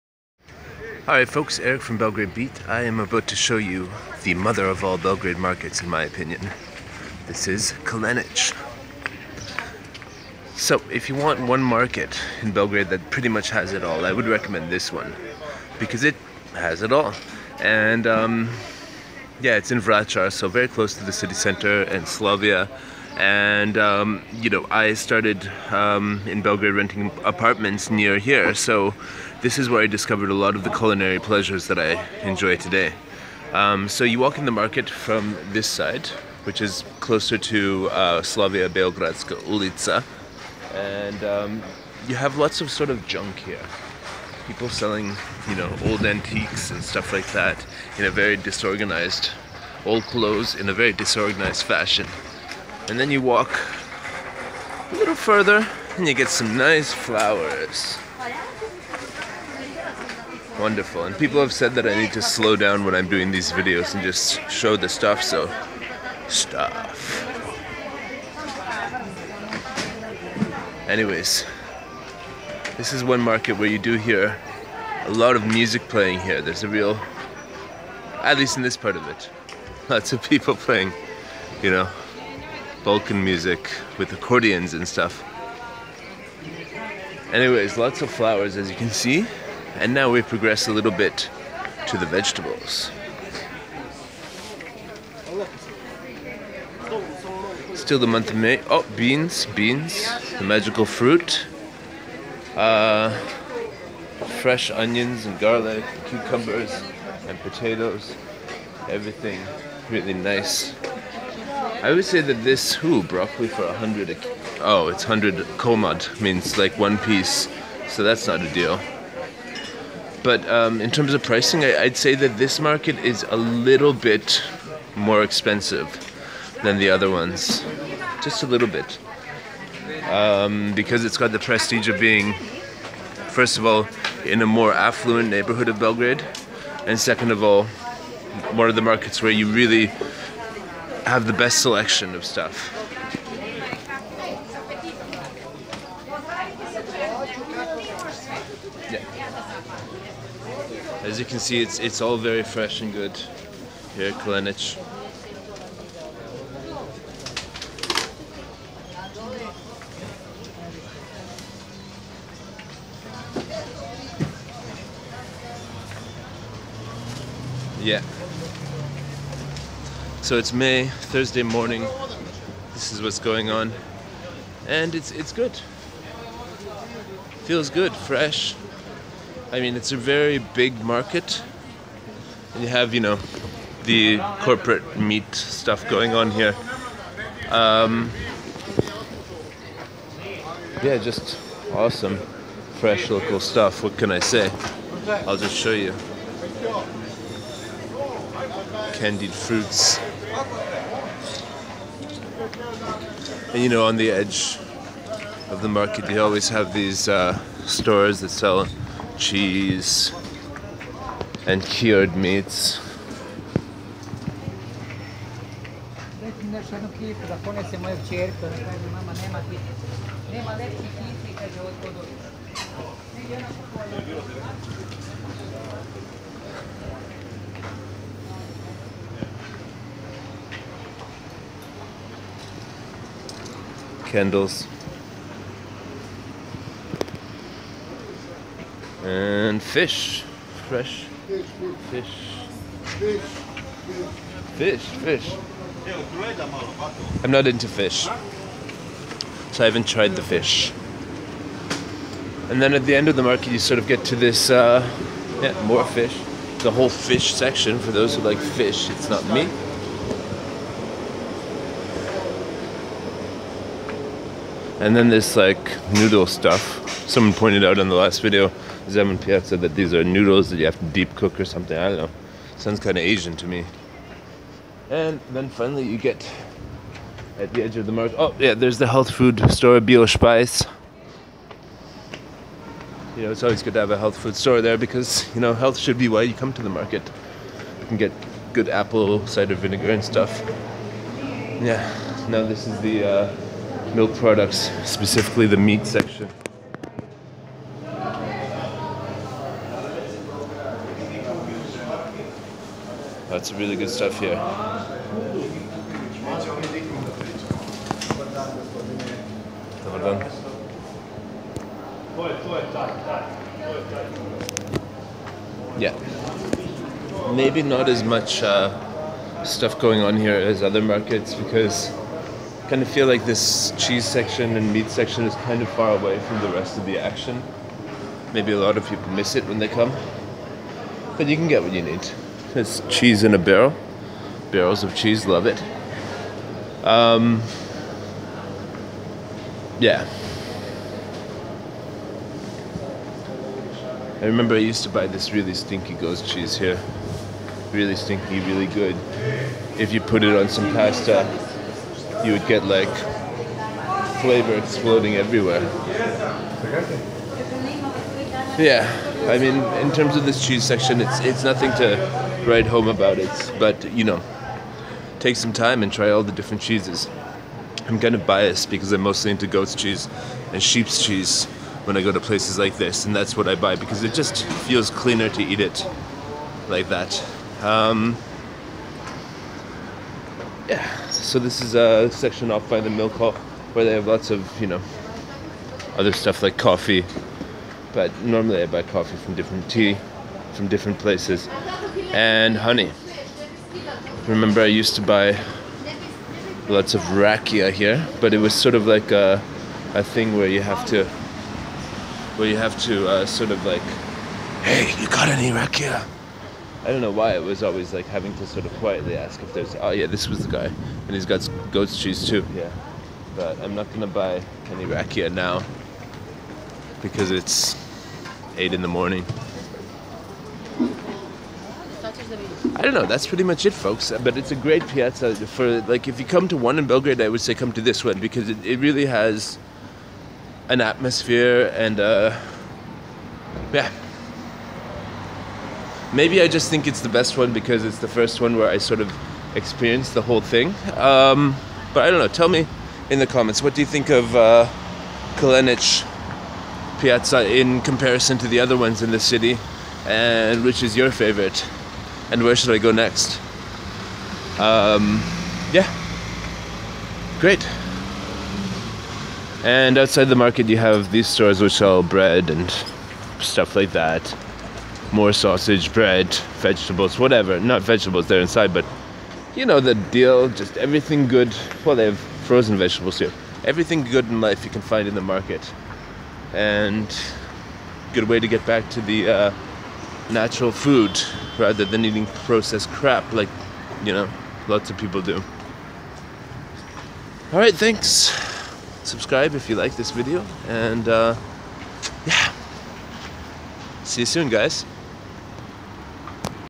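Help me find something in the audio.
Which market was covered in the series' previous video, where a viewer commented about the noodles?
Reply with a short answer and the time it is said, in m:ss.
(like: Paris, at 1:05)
Zemun Pijaca, at 4:28.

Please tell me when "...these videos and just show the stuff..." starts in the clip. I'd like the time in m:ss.
1:03.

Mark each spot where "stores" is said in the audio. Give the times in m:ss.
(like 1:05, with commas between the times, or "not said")
3:27, 4:39, 4:44, 7:41.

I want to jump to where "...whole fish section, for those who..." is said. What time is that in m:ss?
4:16.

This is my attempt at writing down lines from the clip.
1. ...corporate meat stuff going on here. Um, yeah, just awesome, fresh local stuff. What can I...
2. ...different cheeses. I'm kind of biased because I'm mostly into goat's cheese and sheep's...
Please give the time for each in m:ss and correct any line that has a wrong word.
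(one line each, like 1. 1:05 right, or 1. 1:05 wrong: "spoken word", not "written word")
1. 3:04 right
2. 6:06 right.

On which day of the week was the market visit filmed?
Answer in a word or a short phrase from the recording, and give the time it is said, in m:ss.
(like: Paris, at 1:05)
Thursday, at 2:50.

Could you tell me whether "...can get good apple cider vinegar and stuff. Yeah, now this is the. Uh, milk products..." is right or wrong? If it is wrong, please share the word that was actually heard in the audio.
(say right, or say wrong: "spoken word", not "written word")
right.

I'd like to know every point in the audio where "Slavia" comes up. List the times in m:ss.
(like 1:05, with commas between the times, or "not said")
0:22, 0:38.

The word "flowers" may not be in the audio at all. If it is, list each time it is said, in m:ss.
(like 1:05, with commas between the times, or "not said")
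0:56, 1:28.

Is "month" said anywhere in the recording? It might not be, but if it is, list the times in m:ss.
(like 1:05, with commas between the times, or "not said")
1:38.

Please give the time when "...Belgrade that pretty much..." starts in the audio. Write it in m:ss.
0:12.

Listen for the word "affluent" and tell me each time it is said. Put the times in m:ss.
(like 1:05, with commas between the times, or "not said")
2:14.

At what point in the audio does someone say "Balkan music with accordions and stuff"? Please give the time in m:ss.
1:22.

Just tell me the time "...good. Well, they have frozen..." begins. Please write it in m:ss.
7:51.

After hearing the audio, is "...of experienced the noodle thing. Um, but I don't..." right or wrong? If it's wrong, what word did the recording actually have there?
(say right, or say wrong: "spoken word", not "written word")
wrong: "whole", not "noodle".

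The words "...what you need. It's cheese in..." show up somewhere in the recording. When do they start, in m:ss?
5:31.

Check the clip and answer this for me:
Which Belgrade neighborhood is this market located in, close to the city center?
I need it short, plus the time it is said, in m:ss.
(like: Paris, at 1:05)
Vracar, at 0:19.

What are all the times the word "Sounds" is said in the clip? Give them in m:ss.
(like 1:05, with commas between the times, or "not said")
4:32.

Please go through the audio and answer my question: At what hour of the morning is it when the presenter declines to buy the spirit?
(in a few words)
8.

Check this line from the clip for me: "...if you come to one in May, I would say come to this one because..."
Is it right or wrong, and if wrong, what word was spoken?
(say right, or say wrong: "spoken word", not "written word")
wrong: "Belgrade", not "May".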